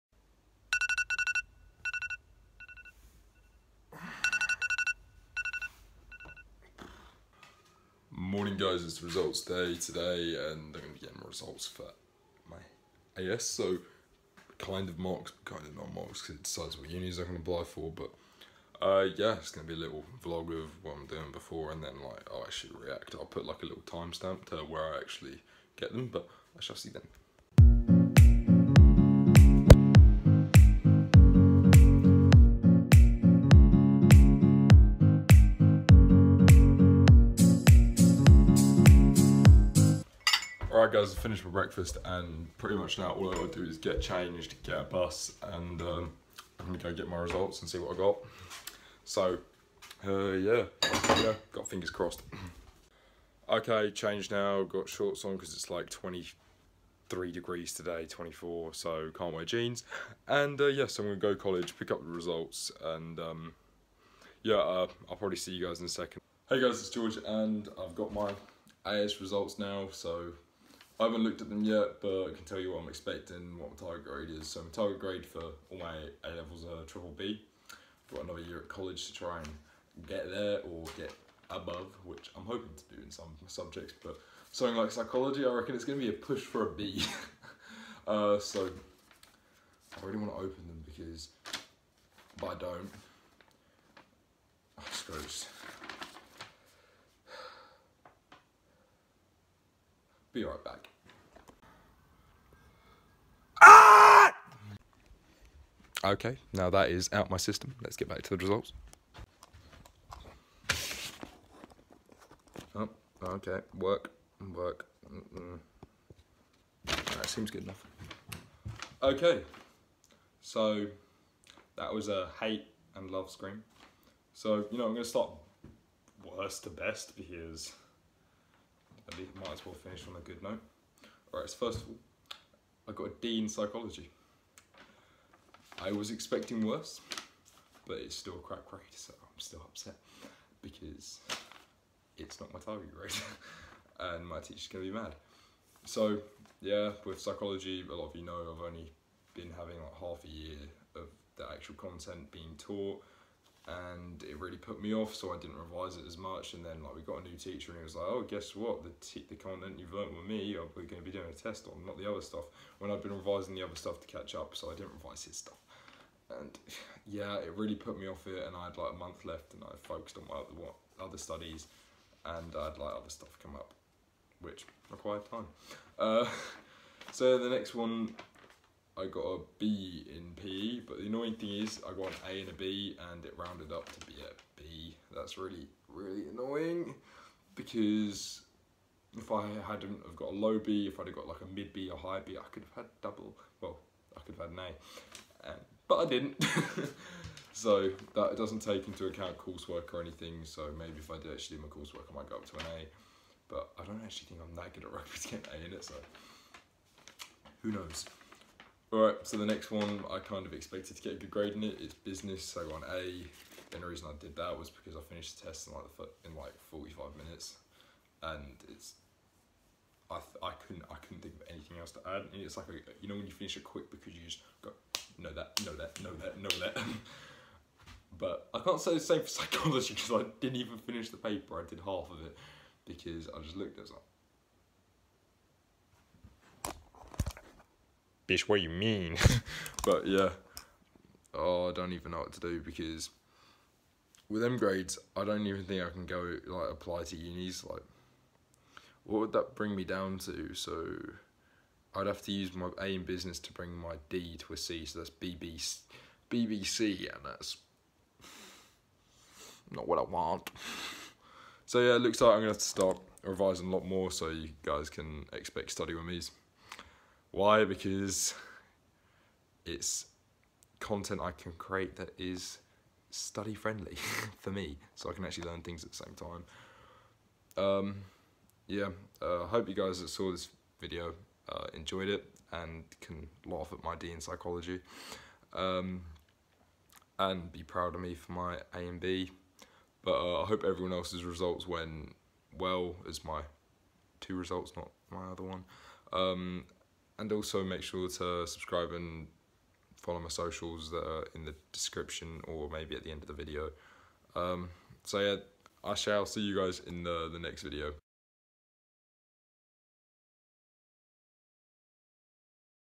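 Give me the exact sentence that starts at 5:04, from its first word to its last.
Um, so yeah, I shall see you guys in the, the next video.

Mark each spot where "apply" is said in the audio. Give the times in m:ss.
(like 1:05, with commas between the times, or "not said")
0:17, 4:06.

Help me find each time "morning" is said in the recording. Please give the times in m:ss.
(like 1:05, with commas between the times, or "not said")
0:08.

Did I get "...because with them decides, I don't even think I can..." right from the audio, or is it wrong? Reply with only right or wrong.
wrong.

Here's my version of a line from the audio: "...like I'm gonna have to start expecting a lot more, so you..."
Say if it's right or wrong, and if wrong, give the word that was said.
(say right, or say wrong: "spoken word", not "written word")
wrong: "revising", not "expecting".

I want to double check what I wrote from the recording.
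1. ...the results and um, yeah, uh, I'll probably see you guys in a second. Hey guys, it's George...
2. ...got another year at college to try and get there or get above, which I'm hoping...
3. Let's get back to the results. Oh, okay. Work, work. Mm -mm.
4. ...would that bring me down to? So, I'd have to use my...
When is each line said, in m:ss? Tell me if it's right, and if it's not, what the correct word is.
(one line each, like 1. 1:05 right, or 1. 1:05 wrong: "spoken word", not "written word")
1. 1:02 right
2. 1:18 right
3. 1:47 right
4. 4:09 right.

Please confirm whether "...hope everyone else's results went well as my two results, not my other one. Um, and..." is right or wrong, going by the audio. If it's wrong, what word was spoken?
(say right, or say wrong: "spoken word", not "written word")
right.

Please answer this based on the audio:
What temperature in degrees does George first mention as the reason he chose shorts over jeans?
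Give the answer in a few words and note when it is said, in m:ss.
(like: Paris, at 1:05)
23, at 0:55.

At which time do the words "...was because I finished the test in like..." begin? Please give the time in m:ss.
3:34.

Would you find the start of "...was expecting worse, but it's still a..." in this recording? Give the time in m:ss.
2:15.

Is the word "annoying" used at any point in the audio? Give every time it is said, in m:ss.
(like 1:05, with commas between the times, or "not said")
3:01, 3:06.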